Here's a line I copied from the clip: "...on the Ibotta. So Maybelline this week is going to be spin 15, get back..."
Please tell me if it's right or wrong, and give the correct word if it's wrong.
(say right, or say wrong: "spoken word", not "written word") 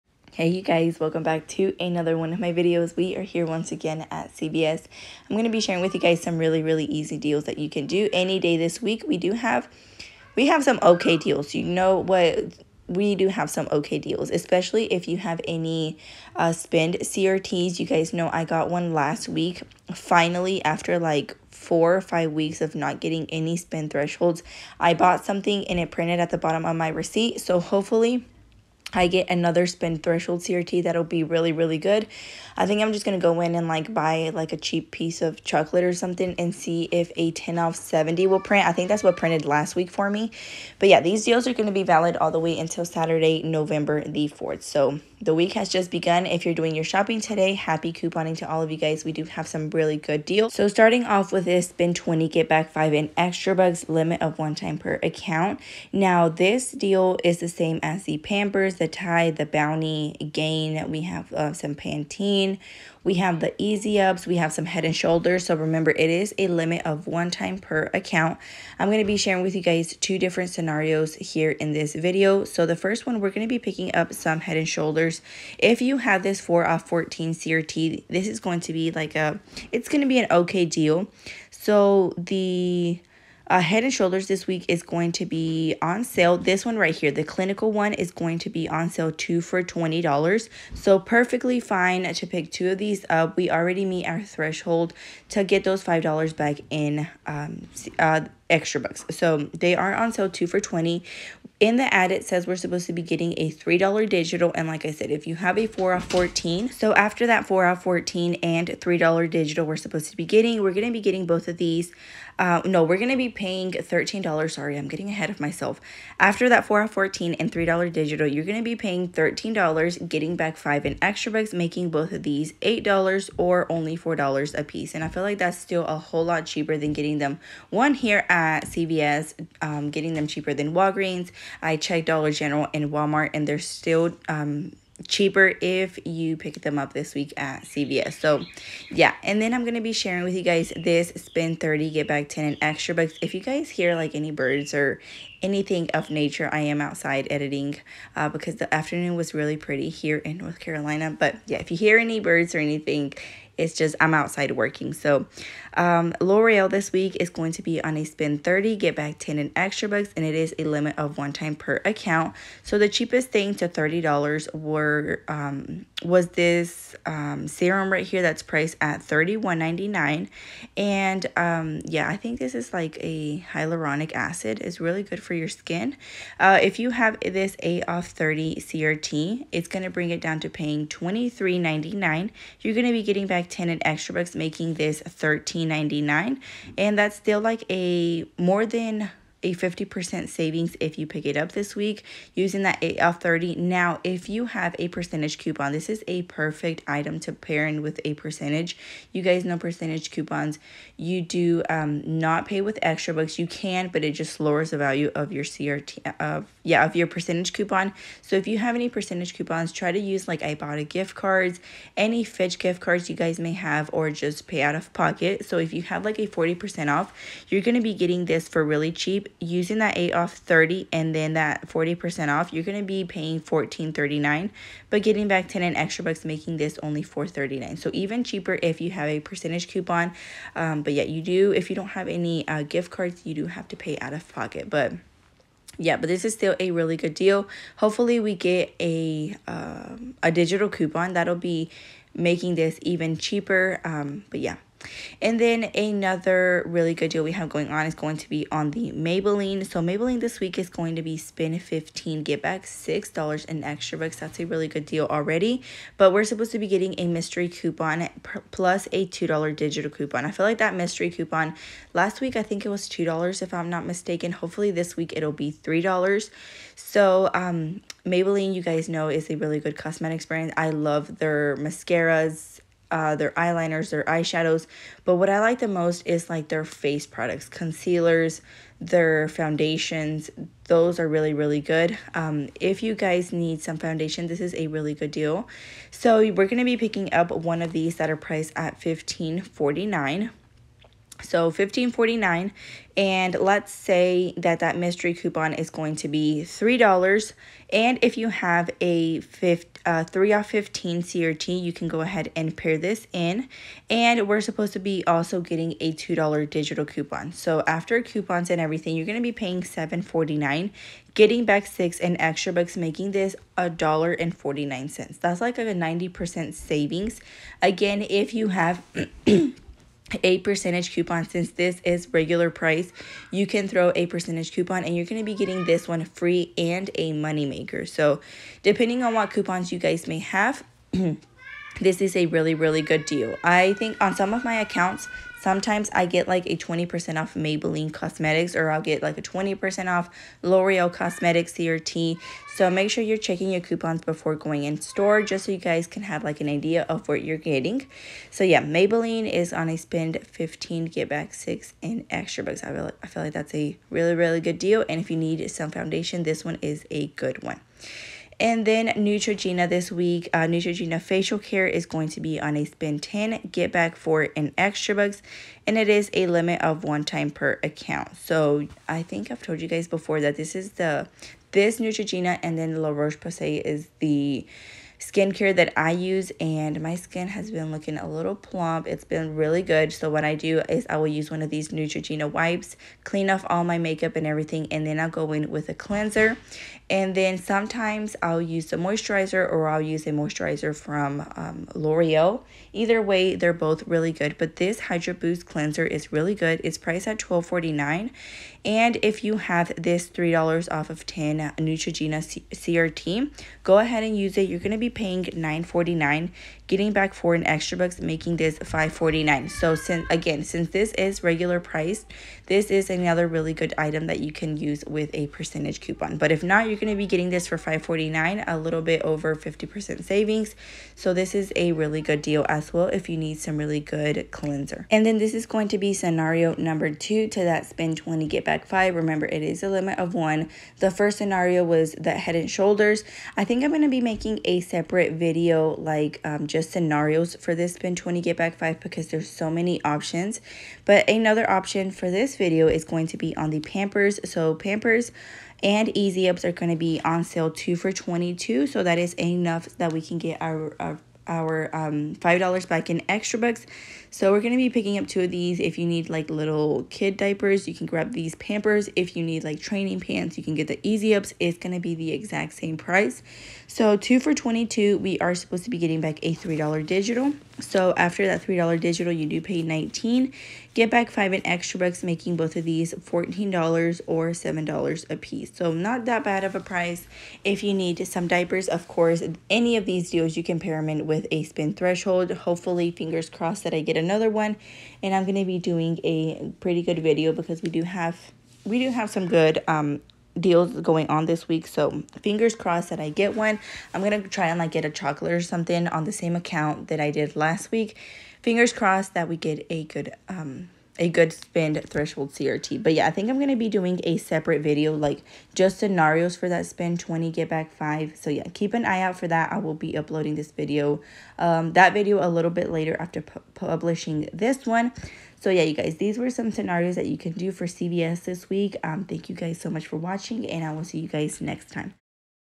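wrong: "Maybelline", not "Ibotta".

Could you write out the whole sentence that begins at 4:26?
So um, Maybelline, you guys know, is a really good cosmetics brand.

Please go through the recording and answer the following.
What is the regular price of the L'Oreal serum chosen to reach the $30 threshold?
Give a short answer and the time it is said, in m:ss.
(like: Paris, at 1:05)
$31.99, at 2:49.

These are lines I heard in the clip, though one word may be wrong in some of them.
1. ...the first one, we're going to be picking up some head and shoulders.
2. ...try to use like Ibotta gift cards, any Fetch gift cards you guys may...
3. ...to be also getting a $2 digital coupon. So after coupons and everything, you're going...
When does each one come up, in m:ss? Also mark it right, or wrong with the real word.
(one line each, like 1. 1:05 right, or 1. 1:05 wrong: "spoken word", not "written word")
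1. 1:12 right
2. 3:29 right
3. 5:04 right.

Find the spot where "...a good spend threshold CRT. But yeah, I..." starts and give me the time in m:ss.
8:21.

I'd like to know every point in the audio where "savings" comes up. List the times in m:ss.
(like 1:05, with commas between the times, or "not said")
3:10, 5:16, 7:00.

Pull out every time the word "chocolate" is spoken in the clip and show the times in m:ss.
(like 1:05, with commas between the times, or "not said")
0:35, 8:14.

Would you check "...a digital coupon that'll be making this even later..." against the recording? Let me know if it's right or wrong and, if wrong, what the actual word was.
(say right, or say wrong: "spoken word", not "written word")
wrong: "cheaper", not "later".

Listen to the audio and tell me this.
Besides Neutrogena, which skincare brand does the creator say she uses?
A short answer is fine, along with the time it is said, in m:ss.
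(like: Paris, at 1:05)
La Roche-Posay, at 6:12.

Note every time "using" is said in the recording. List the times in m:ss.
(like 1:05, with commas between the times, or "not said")
3:12, 3:39.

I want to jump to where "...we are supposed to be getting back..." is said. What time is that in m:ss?
7:44.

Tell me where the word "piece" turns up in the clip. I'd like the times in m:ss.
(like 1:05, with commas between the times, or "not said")
0:34, 2:04, 7:55.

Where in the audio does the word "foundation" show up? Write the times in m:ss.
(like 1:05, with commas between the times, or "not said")
4:39, 4:43, 5:55.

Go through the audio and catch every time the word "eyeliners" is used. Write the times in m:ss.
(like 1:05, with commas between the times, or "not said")
4:33.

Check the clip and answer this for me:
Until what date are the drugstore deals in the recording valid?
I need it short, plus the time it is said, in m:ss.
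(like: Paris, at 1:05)
Saturday, November 4th, at 0:42.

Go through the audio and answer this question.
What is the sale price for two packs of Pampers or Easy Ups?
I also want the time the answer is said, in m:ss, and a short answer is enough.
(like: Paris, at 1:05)
2 for 22, at 7:27.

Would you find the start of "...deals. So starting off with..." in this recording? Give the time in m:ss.
0:50.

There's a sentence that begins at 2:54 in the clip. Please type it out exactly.
It's really good for your skin.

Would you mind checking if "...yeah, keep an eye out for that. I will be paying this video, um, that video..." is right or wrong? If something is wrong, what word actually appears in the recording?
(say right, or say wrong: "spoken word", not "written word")
wrong: "uploading", not "paying".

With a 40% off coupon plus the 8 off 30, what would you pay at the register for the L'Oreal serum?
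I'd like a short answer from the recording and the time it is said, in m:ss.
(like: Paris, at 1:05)
$14.39, at 3:43.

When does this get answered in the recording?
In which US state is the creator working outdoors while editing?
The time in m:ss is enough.
2:30.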